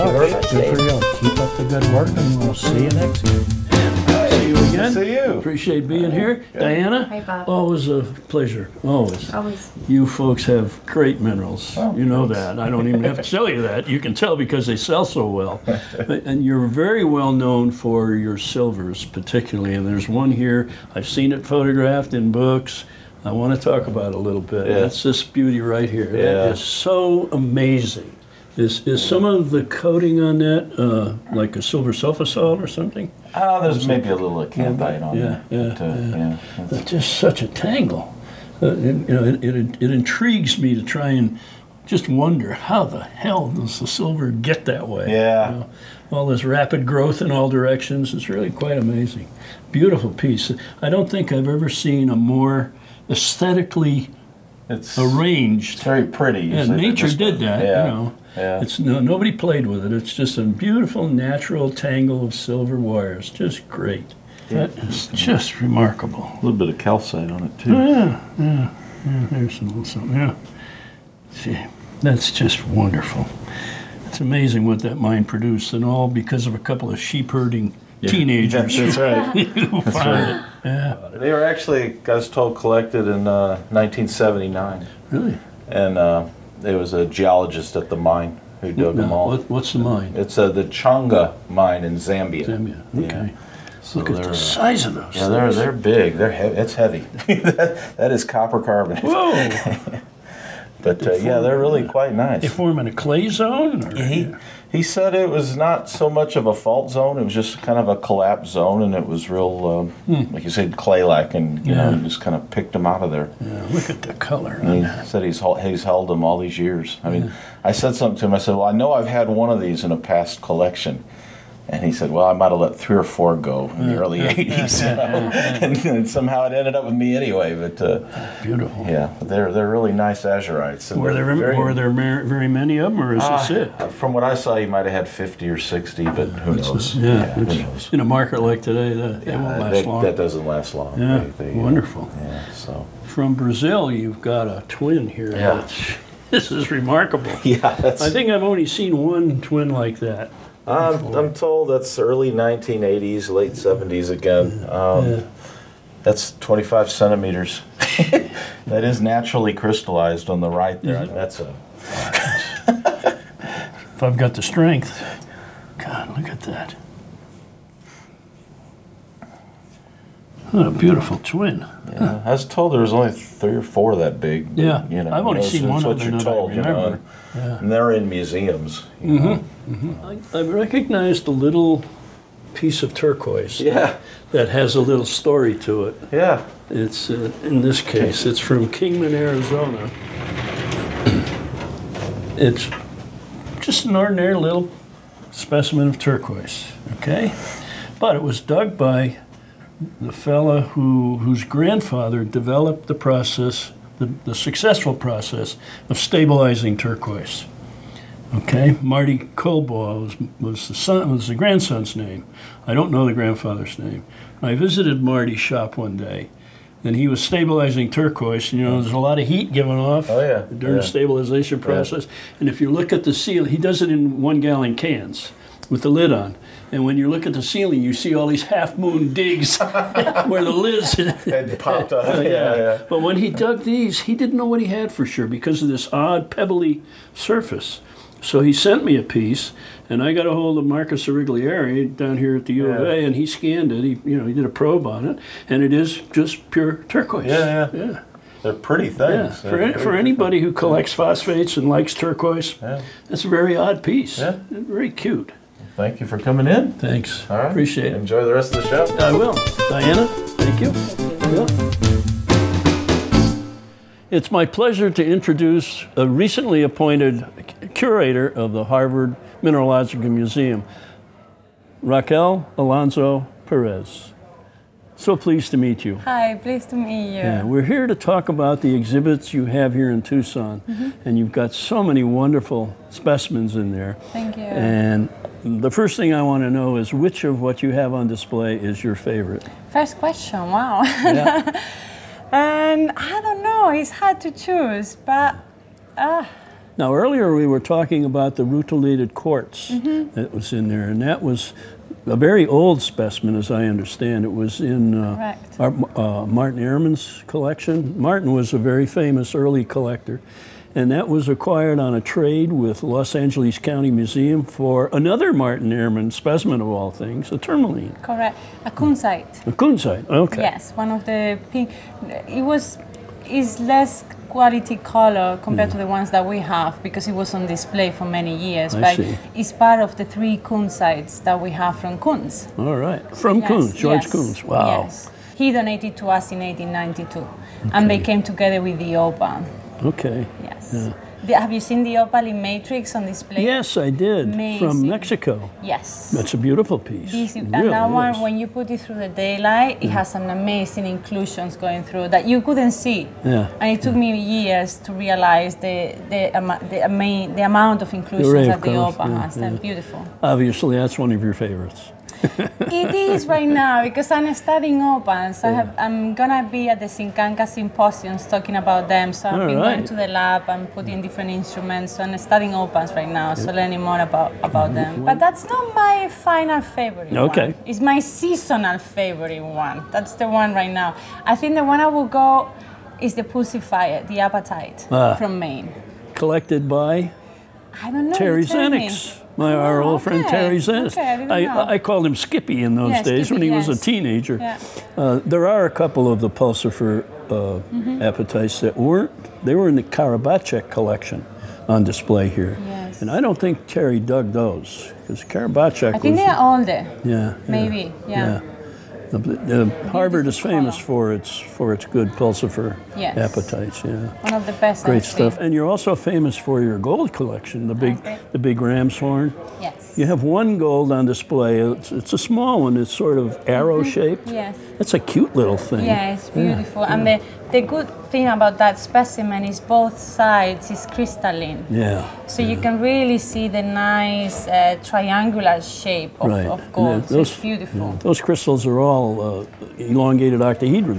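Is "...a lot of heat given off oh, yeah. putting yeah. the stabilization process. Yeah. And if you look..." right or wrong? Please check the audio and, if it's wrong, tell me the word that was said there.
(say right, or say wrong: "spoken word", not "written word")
wrong: "during", not "putting".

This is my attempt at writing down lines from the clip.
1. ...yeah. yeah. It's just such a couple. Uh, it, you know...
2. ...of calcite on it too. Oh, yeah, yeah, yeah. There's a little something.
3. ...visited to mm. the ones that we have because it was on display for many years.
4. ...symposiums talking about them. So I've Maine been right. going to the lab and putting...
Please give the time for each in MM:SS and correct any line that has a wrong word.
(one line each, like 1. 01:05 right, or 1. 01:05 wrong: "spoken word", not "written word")
1. 00:35 wrong: "tangle", not "couple"
2. 01:06 right
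3. 05:25 wrong: "compared", not "visited"
4. 06:07 wrong: "All", not "Maine".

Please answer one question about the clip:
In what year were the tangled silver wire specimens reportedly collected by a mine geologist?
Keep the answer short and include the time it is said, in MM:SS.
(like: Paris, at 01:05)
1979, at 01:23.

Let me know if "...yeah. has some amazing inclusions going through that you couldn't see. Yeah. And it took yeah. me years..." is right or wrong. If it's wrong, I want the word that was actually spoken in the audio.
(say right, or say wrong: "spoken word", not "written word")
right.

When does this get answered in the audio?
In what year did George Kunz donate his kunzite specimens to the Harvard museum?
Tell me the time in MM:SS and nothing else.
05:36.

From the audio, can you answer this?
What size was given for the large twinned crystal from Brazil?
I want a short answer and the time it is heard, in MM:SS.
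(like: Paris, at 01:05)
25 centimeters, at 02:36.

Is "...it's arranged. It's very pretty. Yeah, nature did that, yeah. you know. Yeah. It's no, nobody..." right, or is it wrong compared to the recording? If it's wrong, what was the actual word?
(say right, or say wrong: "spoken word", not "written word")
right.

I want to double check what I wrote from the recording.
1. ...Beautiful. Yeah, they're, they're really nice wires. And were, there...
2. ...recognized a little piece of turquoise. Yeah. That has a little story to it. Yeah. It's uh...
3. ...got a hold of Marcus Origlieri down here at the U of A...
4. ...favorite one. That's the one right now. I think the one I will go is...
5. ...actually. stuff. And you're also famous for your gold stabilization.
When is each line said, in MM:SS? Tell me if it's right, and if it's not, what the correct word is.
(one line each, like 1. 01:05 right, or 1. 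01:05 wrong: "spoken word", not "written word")
1. 02:08 wrong: "azurites", not "wires"
2. 03:00 right
3. 04:00 right
4. 06:18 right
5. 06:55 wrong: "collection", not "stabilization".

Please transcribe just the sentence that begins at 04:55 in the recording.
Uh, now, earlier we were talking about the rutilated quartz mm -hmm.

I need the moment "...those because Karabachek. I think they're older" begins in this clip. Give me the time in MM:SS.
06:44.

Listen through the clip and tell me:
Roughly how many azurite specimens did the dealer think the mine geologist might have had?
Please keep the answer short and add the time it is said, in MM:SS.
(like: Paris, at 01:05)
50 or 60, at 02:15.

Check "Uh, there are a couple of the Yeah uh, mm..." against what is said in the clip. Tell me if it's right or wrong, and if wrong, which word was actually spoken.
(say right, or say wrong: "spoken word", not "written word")
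wrong: "Pulsifer", not "Yeah".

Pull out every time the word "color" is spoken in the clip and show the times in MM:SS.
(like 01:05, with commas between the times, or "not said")
01:54, 05:24.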